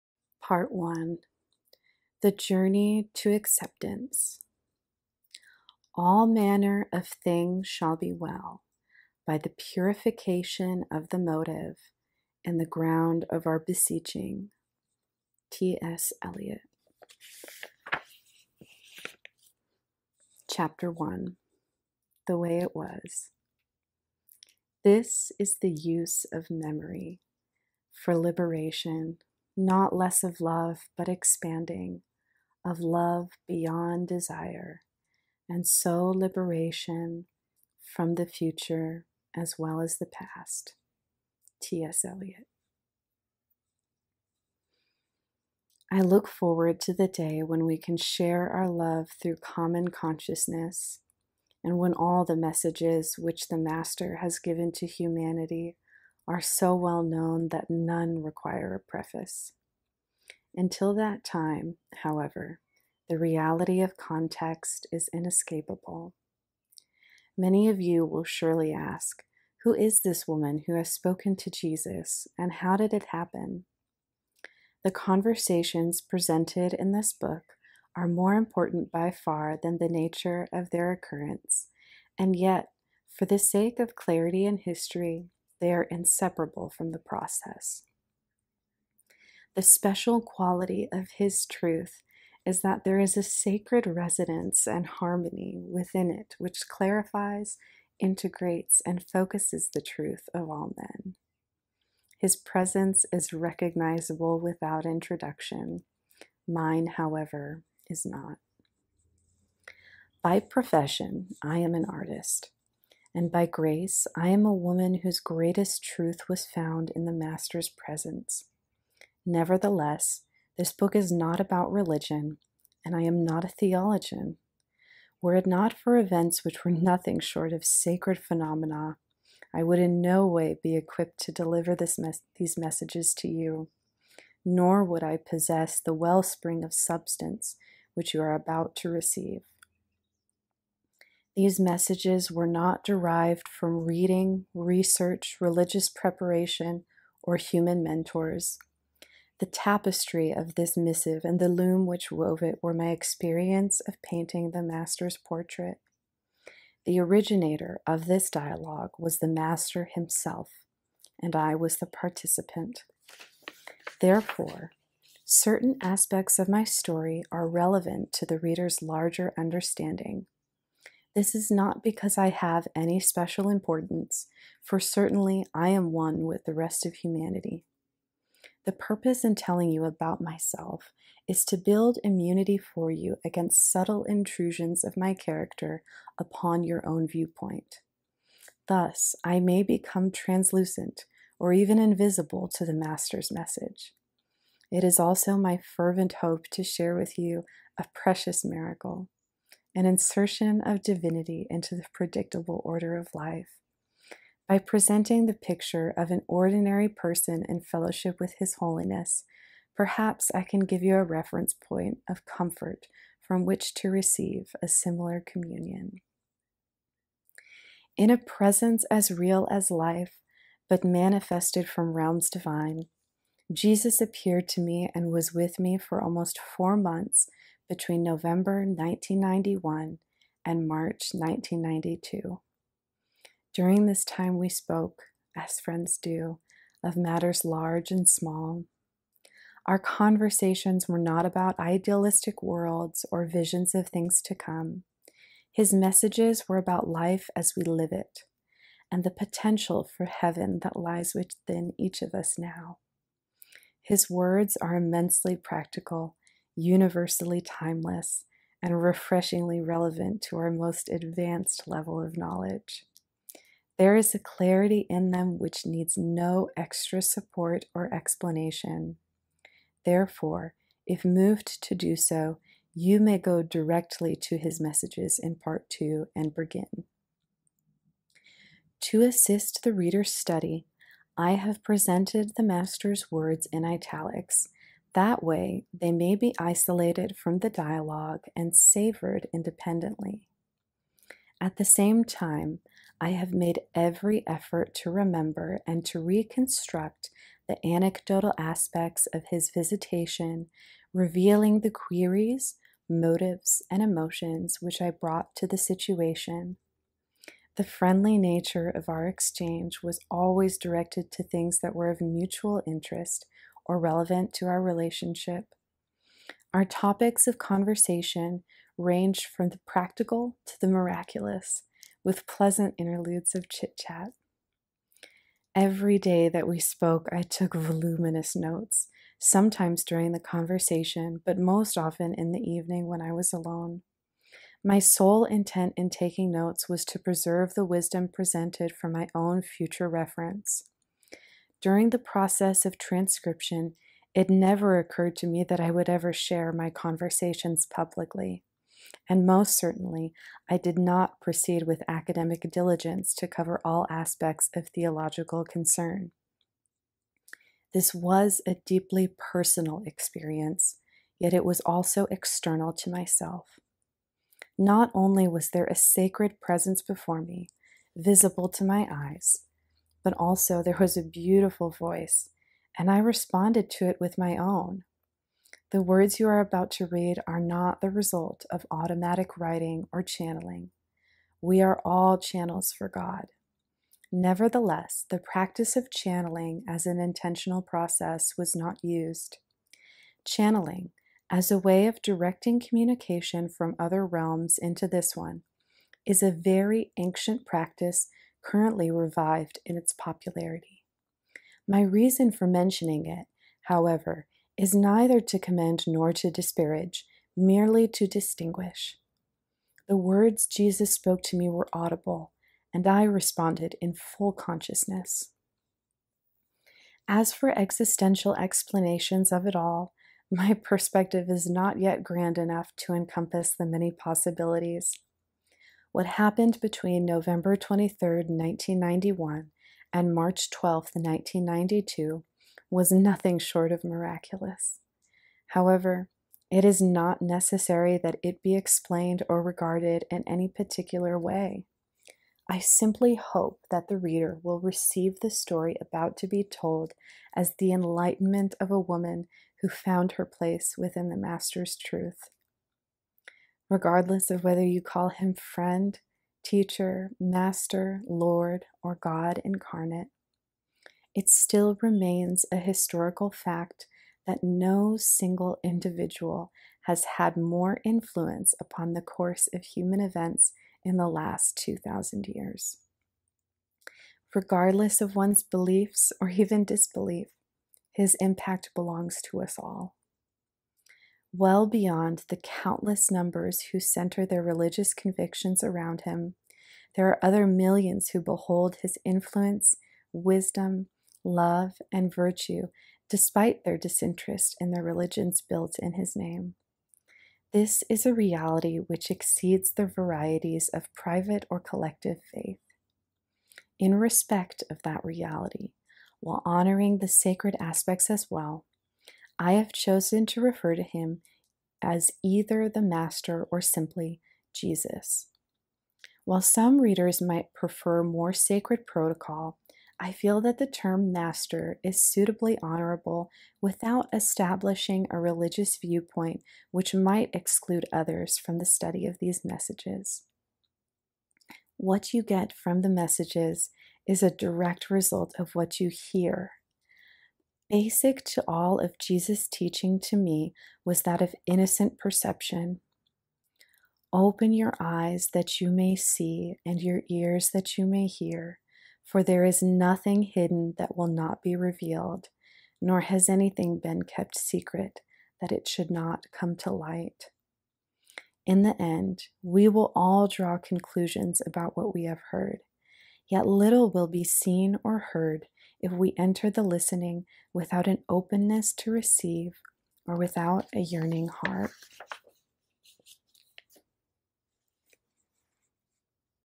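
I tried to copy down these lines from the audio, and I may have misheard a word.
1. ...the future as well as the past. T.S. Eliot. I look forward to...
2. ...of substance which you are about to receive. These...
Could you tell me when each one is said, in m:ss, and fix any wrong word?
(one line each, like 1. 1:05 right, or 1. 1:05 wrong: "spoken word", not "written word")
1. 0:38 right
2. 2:16 right.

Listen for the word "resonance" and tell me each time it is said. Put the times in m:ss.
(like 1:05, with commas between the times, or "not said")
1:33.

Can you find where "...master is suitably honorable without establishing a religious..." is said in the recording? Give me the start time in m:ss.
8:41.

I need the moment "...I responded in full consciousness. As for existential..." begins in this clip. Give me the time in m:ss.
6:52.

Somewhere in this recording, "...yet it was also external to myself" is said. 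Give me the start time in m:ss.
6:01.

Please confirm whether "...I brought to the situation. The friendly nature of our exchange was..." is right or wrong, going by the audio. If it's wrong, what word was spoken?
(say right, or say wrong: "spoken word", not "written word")
right.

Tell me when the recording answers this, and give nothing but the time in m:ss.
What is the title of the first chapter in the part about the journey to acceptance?
0:22.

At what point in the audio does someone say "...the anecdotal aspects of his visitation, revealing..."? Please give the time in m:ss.
4:57.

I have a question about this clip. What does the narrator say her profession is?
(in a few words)
artist.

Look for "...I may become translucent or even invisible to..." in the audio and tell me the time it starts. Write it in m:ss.
3:09.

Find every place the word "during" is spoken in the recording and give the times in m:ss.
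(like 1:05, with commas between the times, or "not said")
3:53, 5:29, 5:41.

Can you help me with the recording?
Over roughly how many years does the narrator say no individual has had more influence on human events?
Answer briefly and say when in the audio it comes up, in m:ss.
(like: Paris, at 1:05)
2,000 years, at 7:51.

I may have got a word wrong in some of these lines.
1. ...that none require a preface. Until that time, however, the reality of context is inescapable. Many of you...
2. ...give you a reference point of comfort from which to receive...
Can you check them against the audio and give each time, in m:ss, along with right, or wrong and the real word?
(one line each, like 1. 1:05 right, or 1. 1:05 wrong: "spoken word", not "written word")
1. 0:57 right
2. 3:30 right.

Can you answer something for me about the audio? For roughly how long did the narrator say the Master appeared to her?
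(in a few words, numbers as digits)
almost four months.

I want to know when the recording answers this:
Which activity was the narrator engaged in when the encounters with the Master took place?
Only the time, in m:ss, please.
2:34.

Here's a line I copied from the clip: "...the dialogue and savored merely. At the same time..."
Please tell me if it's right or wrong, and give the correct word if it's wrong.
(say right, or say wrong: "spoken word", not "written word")
wrong: "independently", not "merely".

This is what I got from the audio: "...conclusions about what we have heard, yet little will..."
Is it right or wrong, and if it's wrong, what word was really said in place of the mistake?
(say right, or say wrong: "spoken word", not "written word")
right.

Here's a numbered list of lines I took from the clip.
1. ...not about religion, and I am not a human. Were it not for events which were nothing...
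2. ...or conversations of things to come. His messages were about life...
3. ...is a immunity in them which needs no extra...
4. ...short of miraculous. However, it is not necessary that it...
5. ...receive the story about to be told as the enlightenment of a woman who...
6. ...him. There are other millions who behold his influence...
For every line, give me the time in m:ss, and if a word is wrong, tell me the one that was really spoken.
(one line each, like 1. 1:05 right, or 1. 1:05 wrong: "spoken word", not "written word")
1. 2:01 wrong: "theologian", not "human"
2. 4:03 wrong: "visions", not "conversations"
3. 4:23 wrong: "clarity", not "immunity"
4. 7:13 right
5. 7:24 right
6. 8:06 right.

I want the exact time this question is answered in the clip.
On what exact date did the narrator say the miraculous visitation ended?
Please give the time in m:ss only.
7:10.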